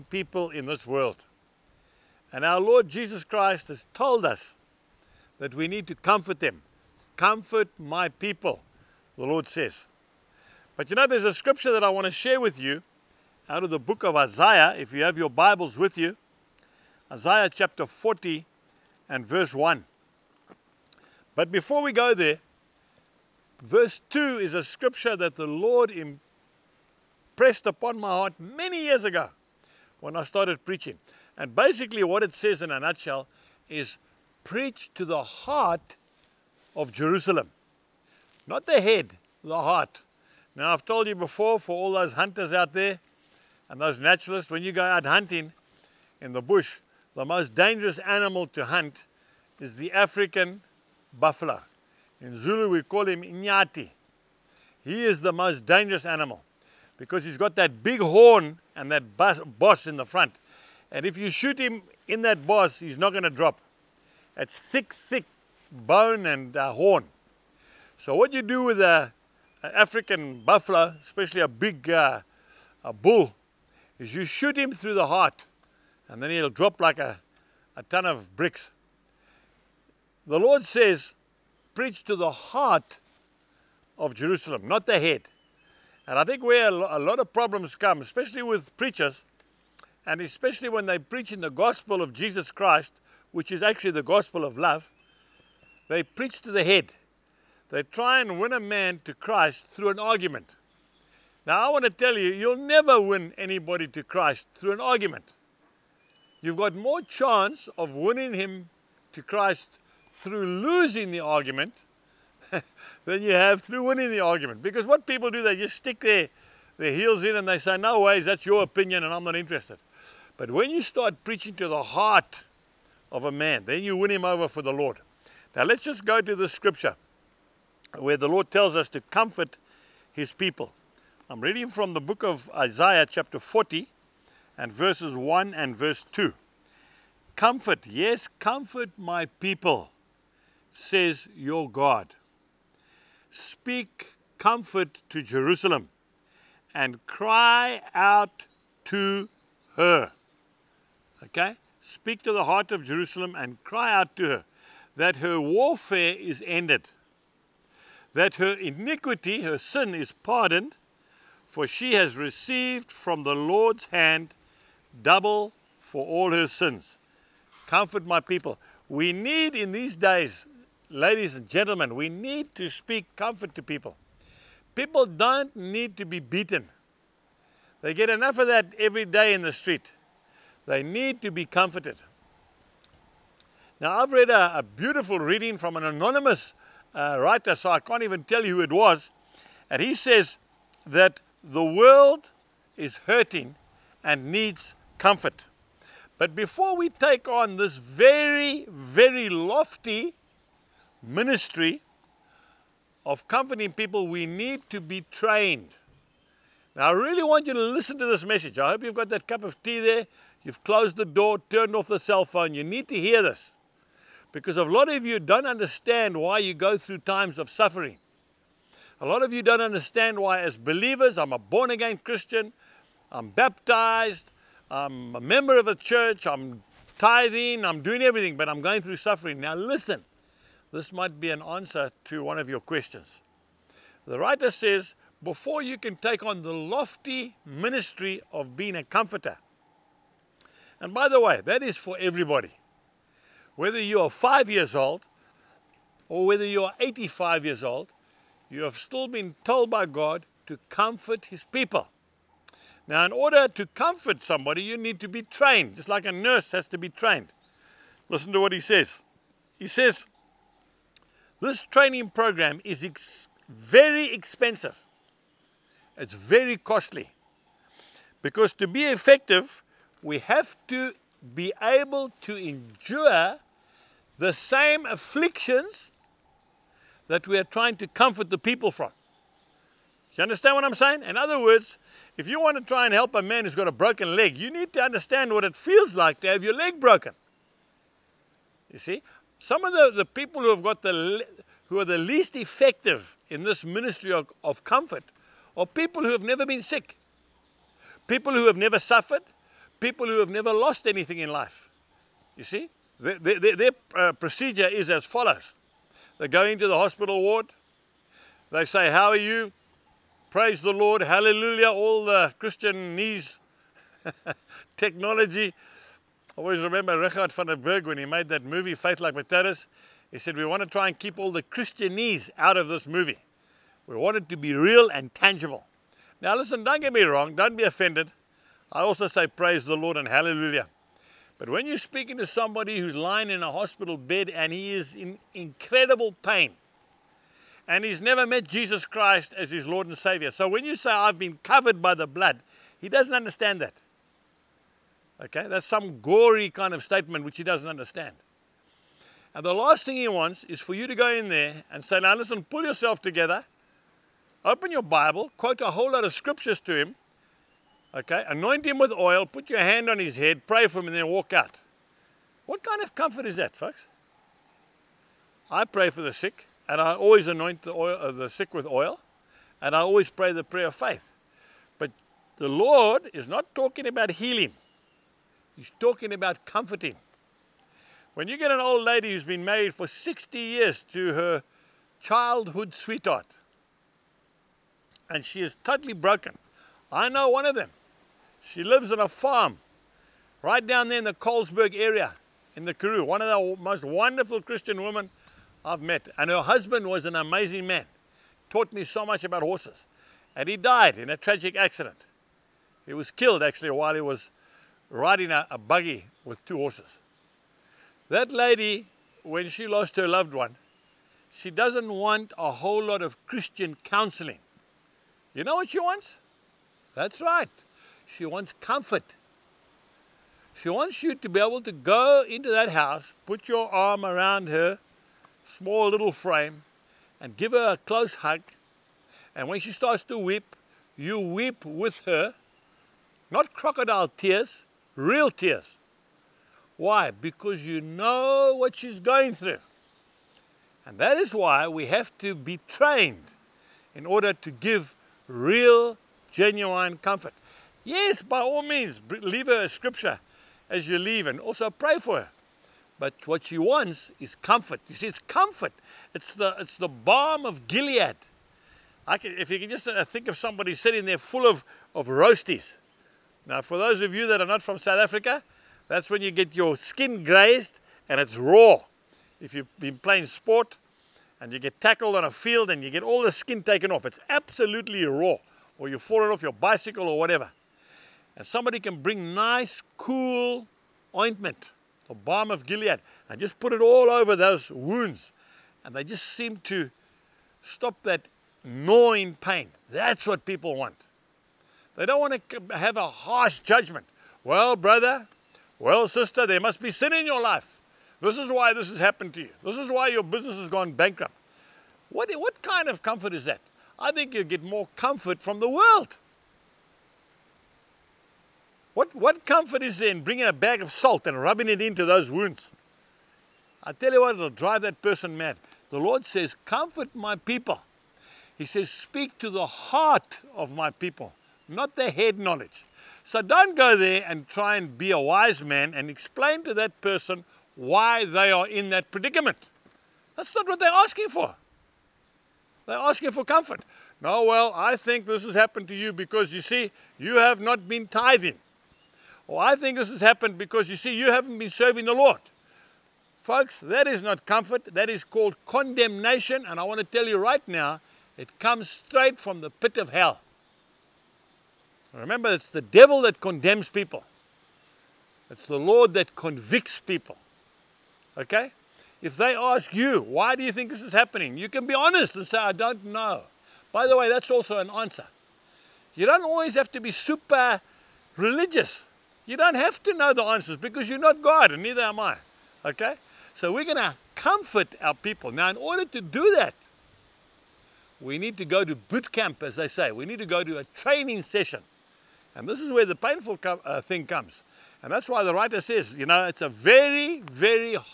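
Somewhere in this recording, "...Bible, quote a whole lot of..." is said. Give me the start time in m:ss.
5:54.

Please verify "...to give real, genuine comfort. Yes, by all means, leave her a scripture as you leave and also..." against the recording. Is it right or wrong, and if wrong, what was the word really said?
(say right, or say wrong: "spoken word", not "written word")
right.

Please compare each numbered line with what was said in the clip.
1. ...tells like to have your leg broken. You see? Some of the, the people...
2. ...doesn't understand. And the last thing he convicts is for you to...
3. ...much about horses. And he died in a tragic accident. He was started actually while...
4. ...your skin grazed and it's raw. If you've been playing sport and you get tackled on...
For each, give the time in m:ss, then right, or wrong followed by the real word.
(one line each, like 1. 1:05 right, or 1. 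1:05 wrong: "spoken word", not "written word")
1. 4:45 wrong: "feels", not "tells"
2. 5:47 wrong: "wants", not "convicts"
3. 6:39 wrong: "killed", not "started"
4. 7:46 right.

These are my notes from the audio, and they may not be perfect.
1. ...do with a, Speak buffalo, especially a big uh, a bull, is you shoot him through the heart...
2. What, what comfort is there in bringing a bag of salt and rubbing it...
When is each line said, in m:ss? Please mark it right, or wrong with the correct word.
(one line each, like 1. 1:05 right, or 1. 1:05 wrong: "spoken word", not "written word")
1. 1:08 wrong: "African", not "Speak"
2. 8:28 right.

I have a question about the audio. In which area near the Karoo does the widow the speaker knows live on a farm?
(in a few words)
Colesberg.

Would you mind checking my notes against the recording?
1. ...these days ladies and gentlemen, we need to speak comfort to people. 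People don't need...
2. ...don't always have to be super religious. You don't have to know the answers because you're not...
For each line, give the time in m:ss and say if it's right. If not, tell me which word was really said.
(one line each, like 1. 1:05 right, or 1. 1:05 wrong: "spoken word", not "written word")
1. 2:49 right
2. 9:26 right.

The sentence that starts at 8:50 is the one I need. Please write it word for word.
That's not what they're asking for.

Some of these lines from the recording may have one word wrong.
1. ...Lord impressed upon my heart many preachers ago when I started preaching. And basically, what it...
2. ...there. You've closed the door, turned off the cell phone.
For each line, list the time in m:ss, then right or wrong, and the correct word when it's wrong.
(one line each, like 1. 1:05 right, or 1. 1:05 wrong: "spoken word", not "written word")
1. 0:25 wrong: "years", not "preachers"
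2. 3:29 right.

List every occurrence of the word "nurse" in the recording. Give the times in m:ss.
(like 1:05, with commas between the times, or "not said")
4:16.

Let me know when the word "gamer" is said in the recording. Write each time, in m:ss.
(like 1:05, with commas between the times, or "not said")
not said.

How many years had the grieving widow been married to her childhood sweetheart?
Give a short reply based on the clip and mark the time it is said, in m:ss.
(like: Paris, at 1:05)
60, at 6:19.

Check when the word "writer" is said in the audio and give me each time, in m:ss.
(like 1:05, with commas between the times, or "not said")
3:07, 3:54, 9:45.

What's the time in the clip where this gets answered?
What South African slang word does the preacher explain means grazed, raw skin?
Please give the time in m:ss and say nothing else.
7:42.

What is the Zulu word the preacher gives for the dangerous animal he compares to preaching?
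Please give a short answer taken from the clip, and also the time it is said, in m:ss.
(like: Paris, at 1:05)
Inyati, at 0:53.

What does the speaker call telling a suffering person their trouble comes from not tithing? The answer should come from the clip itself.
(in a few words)
condemnation.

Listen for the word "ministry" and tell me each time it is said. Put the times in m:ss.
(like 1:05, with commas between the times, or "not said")
3:21, 3:57, 4:53.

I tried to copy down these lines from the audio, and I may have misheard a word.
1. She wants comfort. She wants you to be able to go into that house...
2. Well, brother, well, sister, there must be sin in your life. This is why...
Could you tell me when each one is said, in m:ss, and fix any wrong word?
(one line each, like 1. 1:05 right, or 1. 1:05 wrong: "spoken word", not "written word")
1. 6:58 right
2. 8:14 right.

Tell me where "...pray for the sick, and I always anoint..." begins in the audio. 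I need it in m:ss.
6:05.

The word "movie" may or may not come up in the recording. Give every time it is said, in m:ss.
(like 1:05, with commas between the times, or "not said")
5:18, 5:22.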